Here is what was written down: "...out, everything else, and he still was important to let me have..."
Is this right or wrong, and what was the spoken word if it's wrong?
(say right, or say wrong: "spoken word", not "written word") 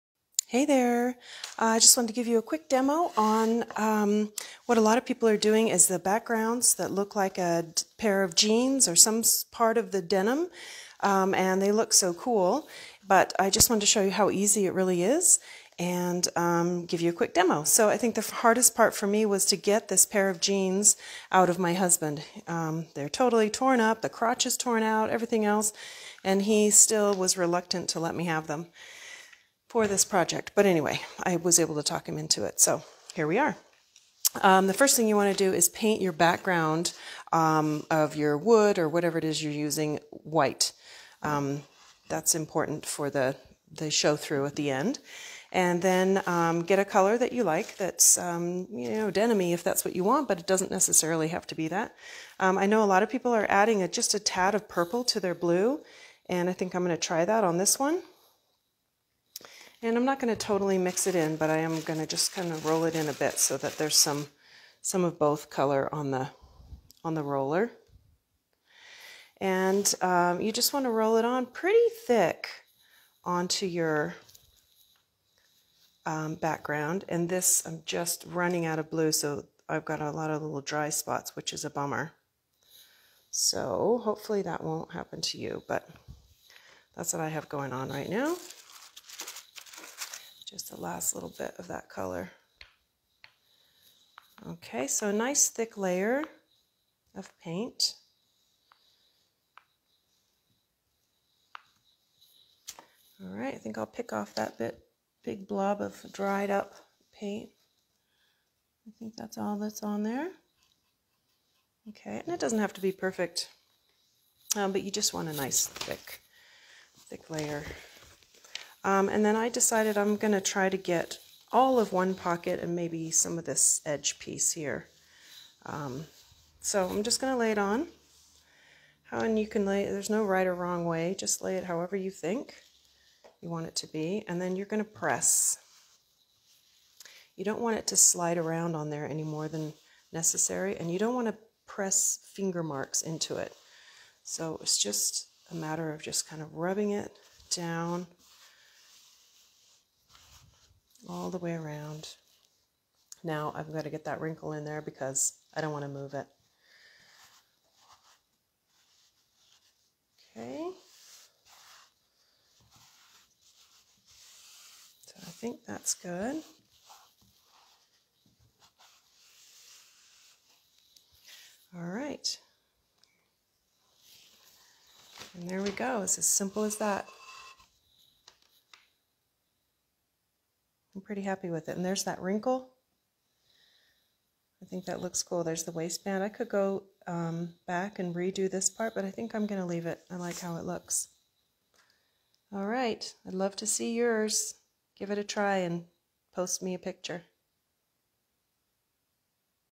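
wrong: "reluctant", not "important".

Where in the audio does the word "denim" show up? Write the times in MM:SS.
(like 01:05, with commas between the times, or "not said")
00:10, 00:49.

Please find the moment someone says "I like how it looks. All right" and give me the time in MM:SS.
03:10.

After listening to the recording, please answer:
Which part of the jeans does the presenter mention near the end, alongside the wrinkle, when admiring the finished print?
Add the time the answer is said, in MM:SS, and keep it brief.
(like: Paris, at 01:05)
The waistband, at 03:05.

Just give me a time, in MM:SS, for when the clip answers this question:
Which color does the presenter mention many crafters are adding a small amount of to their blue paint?
00:54.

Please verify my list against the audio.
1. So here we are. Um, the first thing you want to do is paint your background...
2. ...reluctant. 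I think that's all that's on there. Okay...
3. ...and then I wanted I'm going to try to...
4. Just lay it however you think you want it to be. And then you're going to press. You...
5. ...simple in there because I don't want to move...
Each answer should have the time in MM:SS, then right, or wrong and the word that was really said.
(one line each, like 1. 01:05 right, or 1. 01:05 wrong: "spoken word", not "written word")
1. 00:32 right
2. 01:47 wrong: "paint", not "reluctant"
3. 01:59 wrong: "decided", not "wanted"
4. 02:11 right
5. 02:34 wrong: "wrinkle", not "simple".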